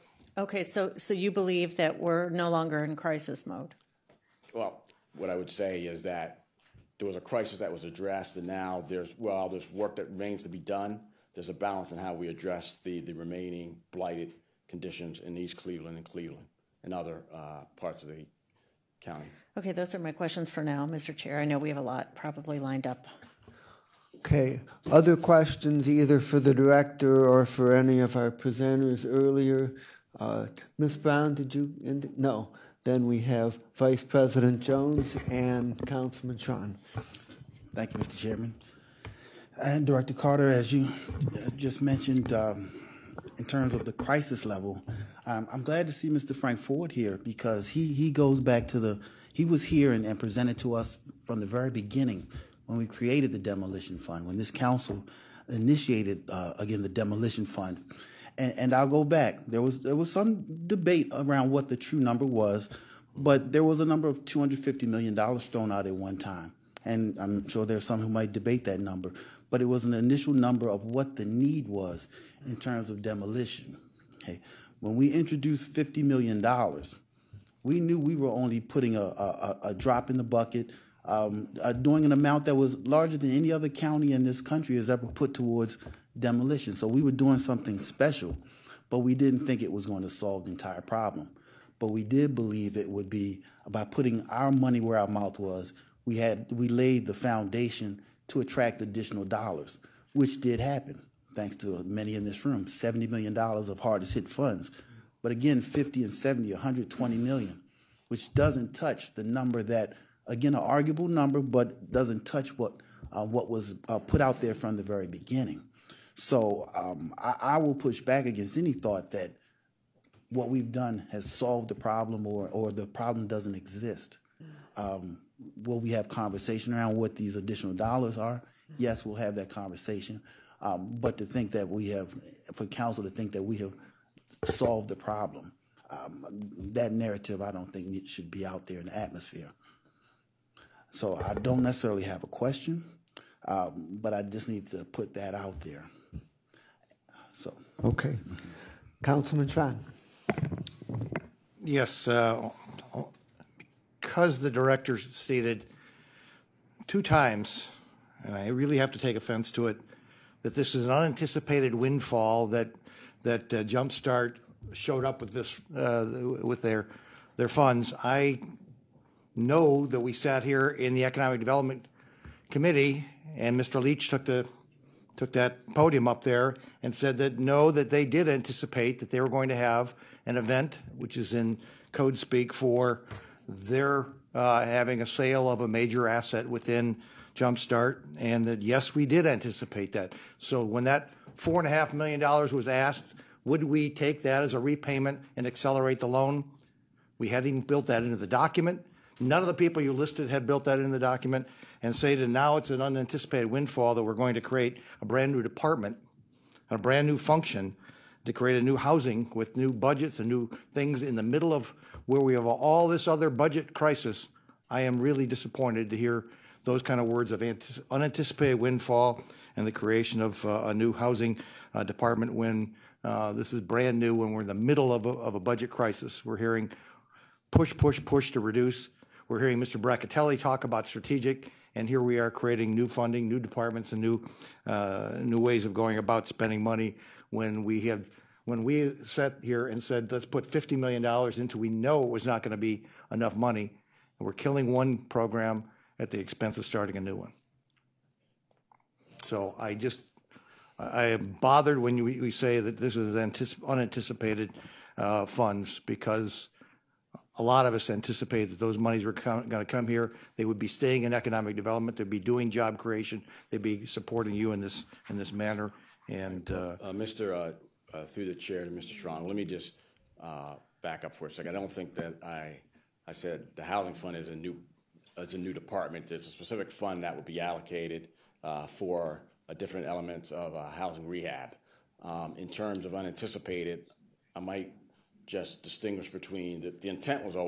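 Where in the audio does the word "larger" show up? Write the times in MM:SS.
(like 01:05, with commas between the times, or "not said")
01:22.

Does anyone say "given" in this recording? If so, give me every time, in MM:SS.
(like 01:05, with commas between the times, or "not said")
not said.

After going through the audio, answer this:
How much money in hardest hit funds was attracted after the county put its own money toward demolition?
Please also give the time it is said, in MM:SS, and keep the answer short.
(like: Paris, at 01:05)
$70 million, at 01:42.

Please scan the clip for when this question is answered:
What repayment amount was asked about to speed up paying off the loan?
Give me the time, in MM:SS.
03:11.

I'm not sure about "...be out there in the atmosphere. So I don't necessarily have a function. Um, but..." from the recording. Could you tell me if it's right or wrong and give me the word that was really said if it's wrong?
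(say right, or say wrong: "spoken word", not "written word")
wrong: "question", not "function".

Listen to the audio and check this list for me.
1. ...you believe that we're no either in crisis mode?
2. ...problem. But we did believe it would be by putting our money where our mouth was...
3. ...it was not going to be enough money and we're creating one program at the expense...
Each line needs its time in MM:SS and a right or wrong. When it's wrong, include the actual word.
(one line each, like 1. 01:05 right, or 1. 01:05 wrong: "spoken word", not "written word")
1. 00:01 wrong: "longer", not "either"
2. 01:30 right
3. 04:02 wrong: "killing", not "creating".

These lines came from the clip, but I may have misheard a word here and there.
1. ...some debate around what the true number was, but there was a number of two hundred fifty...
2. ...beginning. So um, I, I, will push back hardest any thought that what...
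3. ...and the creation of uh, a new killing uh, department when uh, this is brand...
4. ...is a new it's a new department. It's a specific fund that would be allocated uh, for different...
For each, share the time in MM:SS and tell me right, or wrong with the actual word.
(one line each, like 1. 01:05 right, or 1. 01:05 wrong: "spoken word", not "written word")
1. 01:00 right
2. 01:55 wrong: "against", not "hardest"
3. 03:39 wrong: "housing", not "killing"
4. 04:34 right.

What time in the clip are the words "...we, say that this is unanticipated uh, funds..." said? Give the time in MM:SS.
04:12.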